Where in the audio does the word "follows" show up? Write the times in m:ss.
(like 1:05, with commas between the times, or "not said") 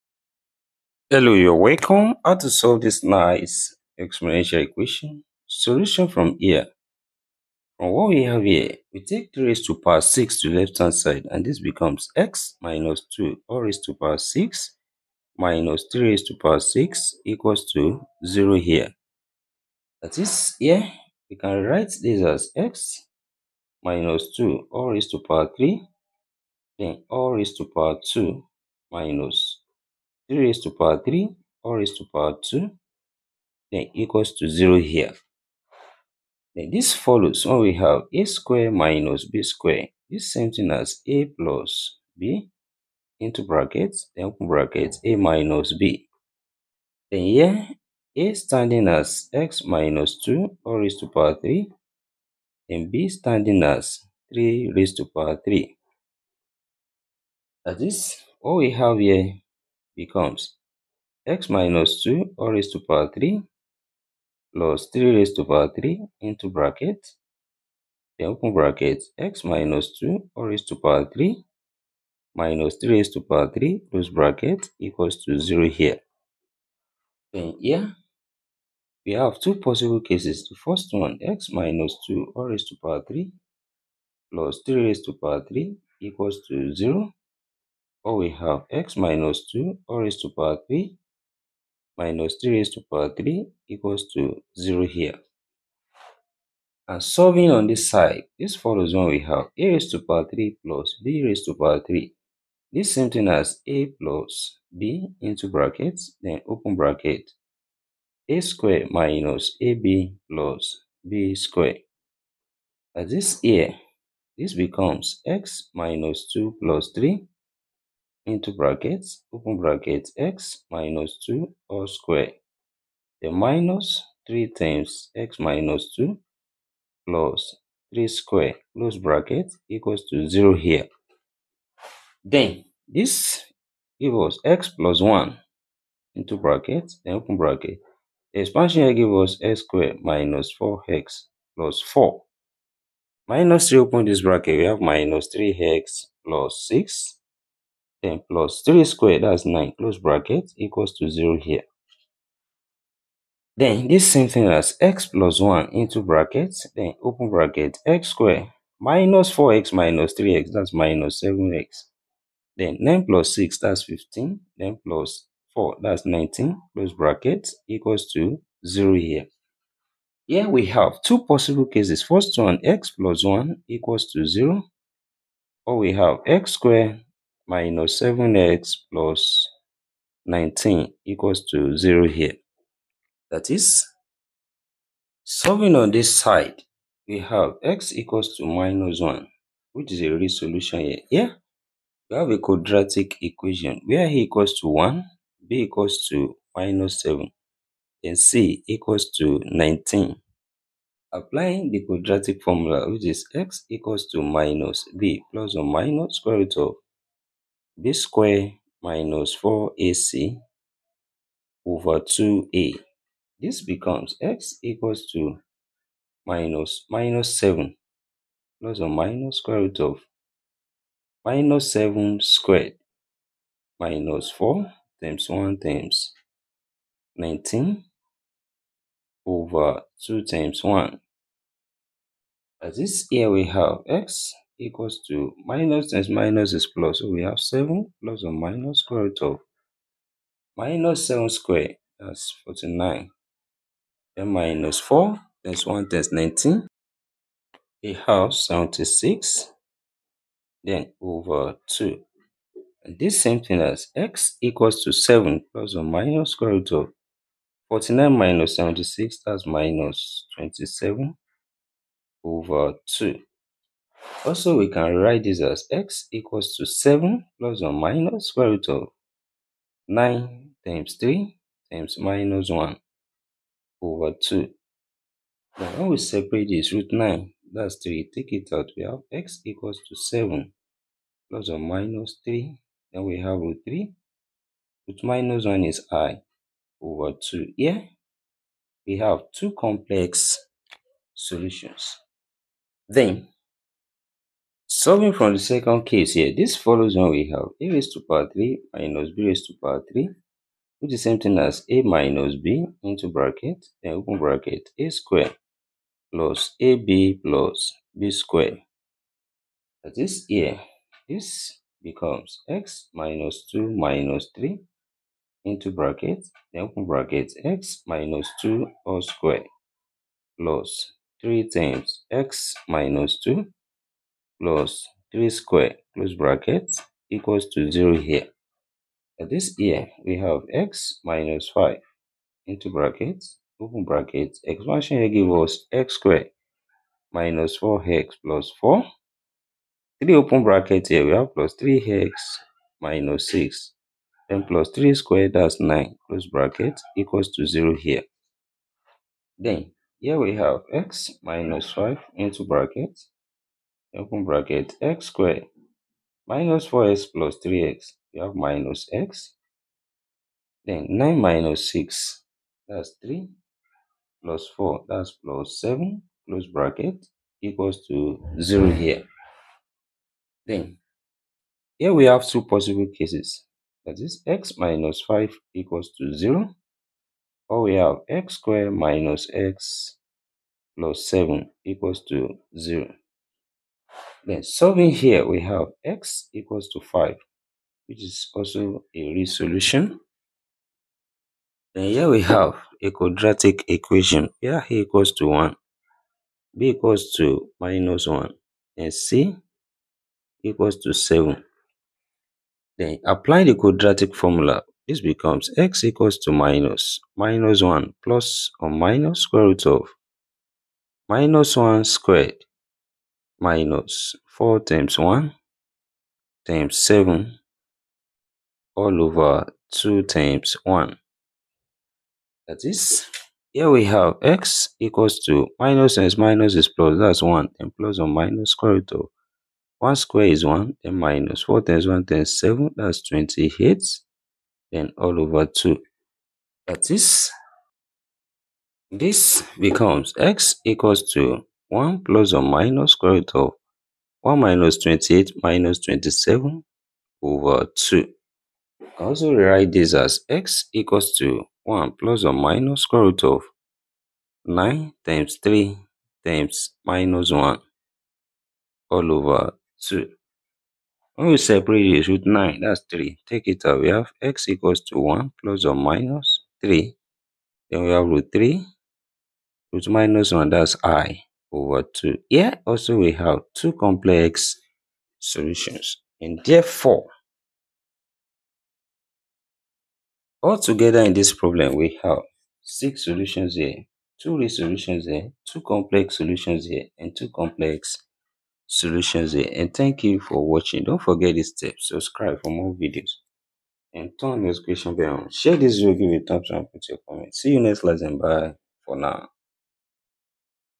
0:36, 1:38, 4:56.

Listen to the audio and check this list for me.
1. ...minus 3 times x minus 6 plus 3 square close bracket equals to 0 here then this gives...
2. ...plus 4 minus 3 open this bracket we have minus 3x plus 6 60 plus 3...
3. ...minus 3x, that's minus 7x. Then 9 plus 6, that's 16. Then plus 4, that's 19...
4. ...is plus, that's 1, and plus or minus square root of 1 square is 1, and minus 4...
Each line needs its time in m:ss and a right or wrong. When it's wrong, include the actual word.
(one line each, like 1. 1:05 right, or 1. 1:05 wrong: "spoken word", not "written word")
1. 2:03 wrong: "2", not "6"
2. 2:21 wrong: "10", not "60"
3. 2:39 wrong: "15", not "16"
4. 7:06 right.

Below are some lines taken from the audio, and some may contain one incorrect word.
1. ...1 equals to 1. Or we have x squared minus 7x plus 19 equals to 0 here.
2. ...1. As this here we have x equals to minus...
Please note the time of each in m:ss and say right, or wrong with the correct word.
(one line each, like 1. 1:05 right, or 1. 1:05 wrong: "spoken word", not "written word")
1. 2:53 wrong: "0", not "1"
2. 3:50 right.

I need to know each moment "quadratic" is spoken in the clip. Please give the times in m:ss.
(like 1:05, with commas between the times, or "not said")
3:12, 3:21, 6:32, 6:43.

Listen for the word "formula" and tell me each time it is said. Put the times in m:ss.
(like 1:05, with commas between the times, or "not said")
3:22, 6:44.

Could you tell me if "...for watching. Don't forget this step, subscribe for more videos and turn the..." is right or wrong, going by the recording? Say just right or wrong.
right.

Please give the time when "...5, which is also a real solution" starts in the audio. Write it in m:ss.
6:26.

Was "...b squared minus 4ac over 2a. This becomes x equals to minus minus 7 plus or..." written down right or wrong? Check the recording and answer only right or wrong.
right.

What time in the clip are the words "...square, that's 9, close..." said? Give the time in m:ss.
5:44.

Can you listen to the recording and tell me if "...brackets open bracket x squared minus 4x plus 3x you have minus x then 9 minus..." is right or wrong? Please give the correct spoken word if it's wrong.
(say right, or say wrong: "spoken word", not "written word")
right.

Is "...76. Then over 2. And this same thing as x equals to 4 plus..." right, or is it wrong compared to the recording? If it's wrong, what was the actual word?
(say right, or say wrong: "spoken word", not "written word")
wrong: "7", not "4".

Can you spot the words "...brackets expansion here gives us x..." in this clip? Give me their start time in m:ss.
5:33.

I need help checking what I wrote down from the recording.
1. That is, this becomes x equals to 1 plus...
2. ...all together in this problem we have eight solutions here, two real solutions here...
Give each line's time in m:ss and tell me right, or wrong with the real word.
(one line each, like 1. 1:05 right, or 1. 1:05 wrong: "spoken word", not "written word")
1. 7:16 right
2. 8:00 wrong: "six", not "eight".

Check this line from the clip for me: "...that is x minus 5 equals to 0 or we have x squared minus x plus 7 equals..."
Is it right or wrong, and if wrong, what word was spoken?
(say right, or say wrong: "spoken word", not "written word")
right.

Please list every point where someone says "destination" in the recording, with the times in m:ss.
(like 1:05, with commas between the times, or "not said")
not said.